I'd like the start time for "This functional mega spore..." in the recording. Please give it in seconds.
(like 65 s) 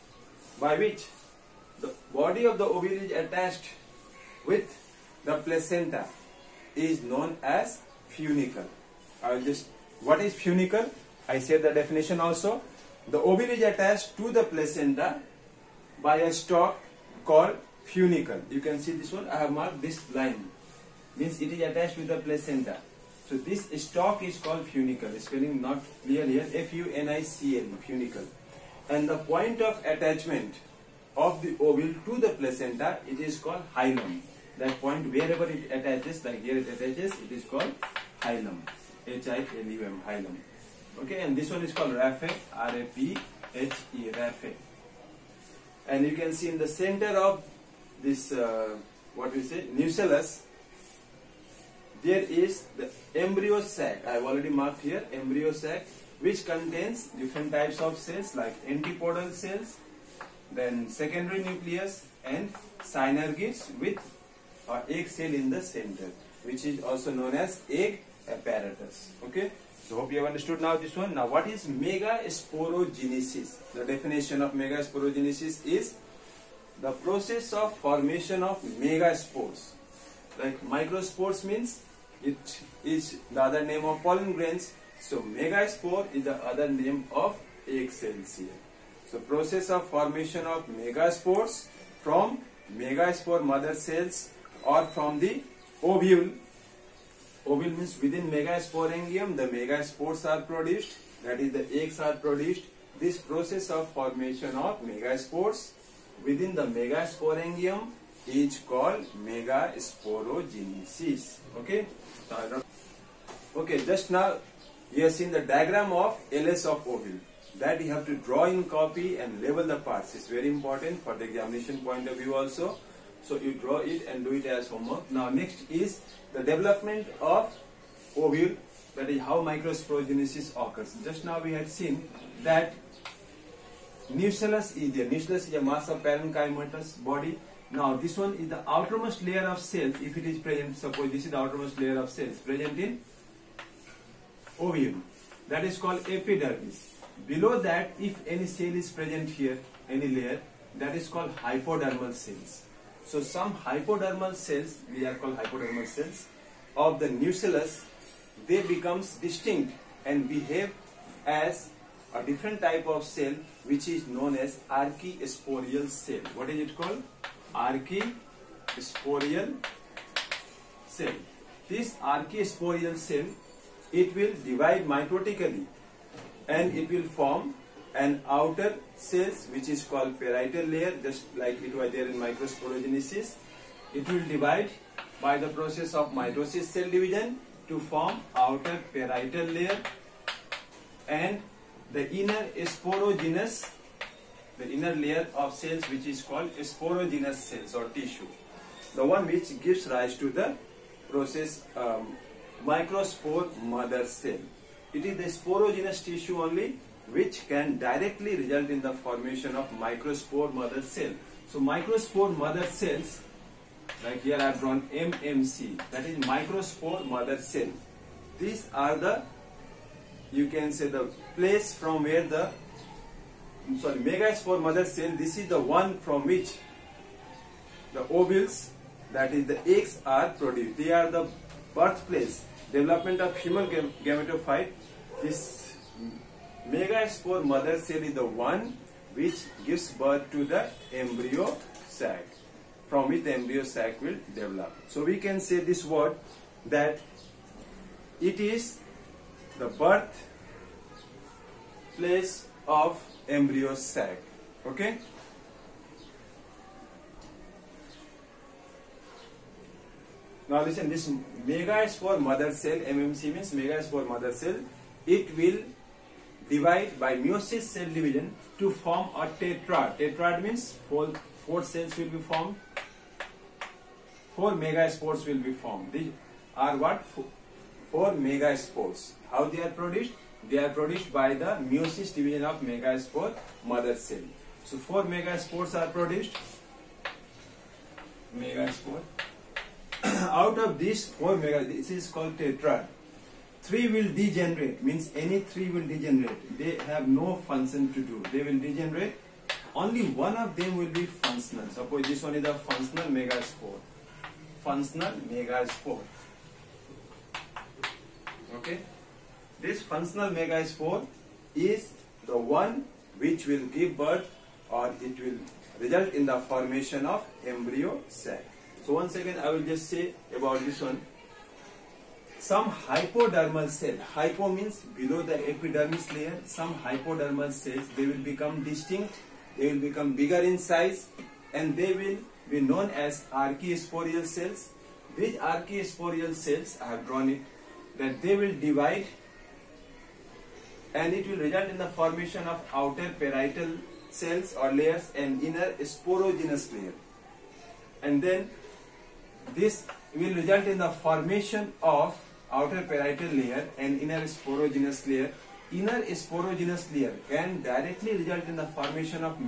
309 s.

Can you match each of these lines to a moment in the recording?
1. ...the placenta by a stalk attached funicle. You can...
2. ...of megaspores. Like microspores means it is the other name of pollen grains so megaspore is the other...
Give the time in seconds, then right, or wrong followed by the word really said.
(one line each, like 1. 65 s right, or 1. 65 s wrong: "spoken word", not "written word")
1. 14 s wrong: "called", not "attached"
2. 78 s right.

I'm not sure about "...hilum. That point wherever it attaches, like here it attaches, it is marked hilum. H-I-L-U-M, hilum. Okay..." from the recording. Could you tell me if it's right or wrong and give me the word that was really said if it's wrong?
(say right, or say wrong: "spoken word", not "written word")
wrong: "called", not "marked".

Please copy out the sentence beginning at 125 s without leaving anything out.
Now next is the development of ovule.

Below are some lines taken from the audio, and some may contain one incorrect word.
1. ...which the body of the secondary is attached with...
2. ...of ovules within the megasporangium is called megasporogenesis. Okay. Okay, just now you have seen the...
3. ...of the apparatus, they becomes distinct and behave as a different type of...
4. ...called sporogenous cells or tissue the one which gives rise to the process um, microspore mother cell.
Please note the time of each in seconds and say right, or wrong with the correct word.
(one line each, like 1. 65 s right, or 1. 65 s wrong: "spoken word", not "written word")
1. 0 s wrong: "ovary", not "secondary"
2. 104 s wrong: "megaspores", not "ovules"
3. 156 s wrong: "nucellus", not "apparatus"
4. 196 s right.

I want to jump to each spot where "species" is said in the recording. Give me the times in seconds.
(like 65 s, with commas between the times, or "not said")
not said.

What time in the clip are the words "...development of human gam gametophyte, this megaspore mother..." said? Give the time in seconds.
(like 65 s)
232 s.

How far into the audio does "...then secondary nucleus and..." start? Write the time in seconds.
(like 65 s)
60 s.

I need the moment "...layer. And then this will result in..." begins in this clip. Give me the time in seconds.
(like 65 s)
346 s.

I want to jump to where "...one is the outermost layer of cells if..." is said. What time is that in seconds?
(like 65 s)
138 s.